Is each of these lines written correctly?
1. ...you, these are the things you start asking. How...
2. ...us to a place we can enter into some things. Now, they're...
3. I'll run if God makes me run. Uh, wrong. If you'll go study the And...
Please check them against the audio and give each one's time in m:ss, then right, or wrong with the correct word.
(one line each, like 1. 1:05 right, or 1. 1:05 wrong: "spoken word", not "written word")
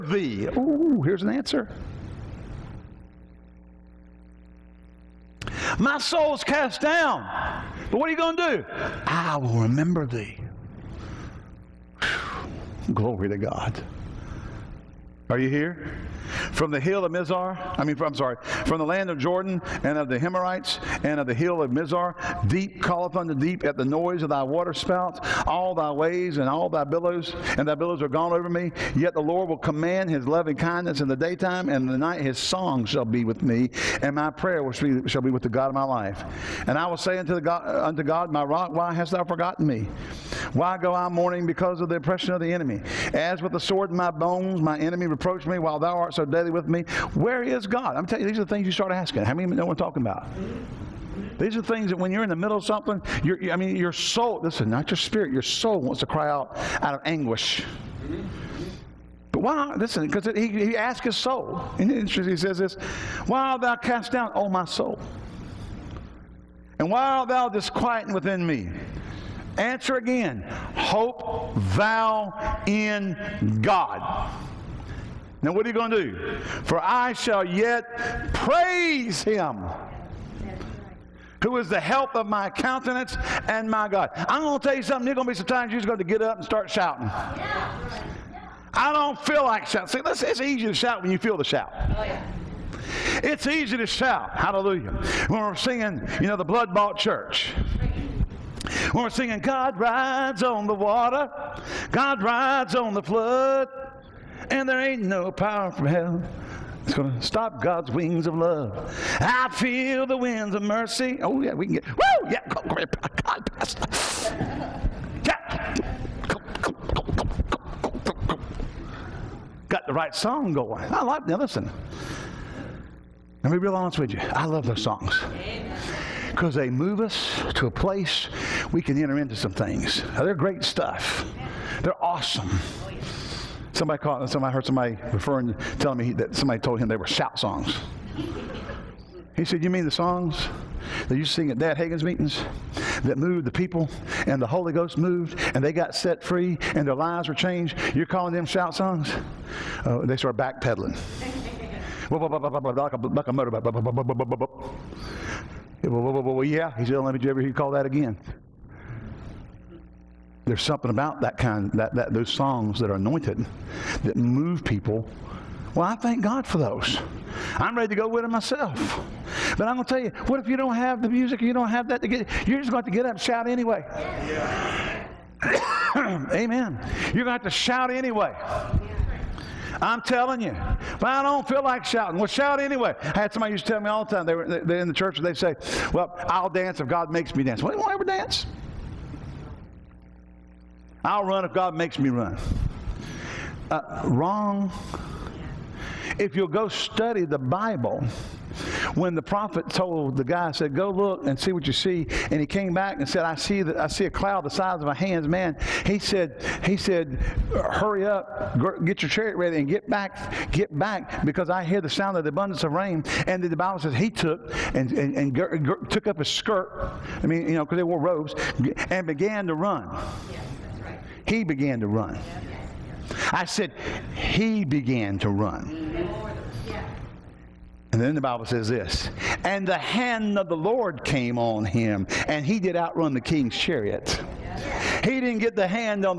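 1. 0:48 right
2. 2:06 right
3. 3:11 wrong: "Bible", not "And".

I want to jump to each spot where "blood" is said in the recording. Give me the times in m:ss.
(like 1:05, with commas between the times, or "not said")
1:36.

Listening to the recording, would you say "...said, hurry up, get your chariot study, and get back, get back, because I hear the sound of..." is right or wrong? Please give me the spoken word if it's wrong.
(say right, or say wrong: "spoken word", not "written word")
wrong: "ready", not "study".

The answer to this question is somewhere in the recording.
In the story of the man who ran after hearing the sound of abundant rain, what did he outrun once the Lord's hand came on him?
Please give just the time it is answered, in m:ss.
3:53.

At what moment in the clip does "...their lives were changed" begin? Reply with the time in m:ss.
2:26.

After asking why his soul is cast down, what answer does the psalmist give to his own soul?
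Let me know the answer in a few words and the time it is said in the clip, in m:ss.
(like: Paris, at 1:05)
Hope thou in God, at 1:10.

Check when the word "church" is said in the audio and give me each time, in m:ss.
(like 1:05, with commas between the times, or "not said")
1:36, 3:04.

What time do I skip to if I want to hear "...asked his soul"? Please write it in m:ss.
1:00.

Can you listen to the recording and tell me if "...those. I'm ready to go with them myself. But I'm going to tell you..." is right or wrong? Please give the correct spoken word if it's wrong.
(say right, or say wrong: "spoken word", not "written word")
right.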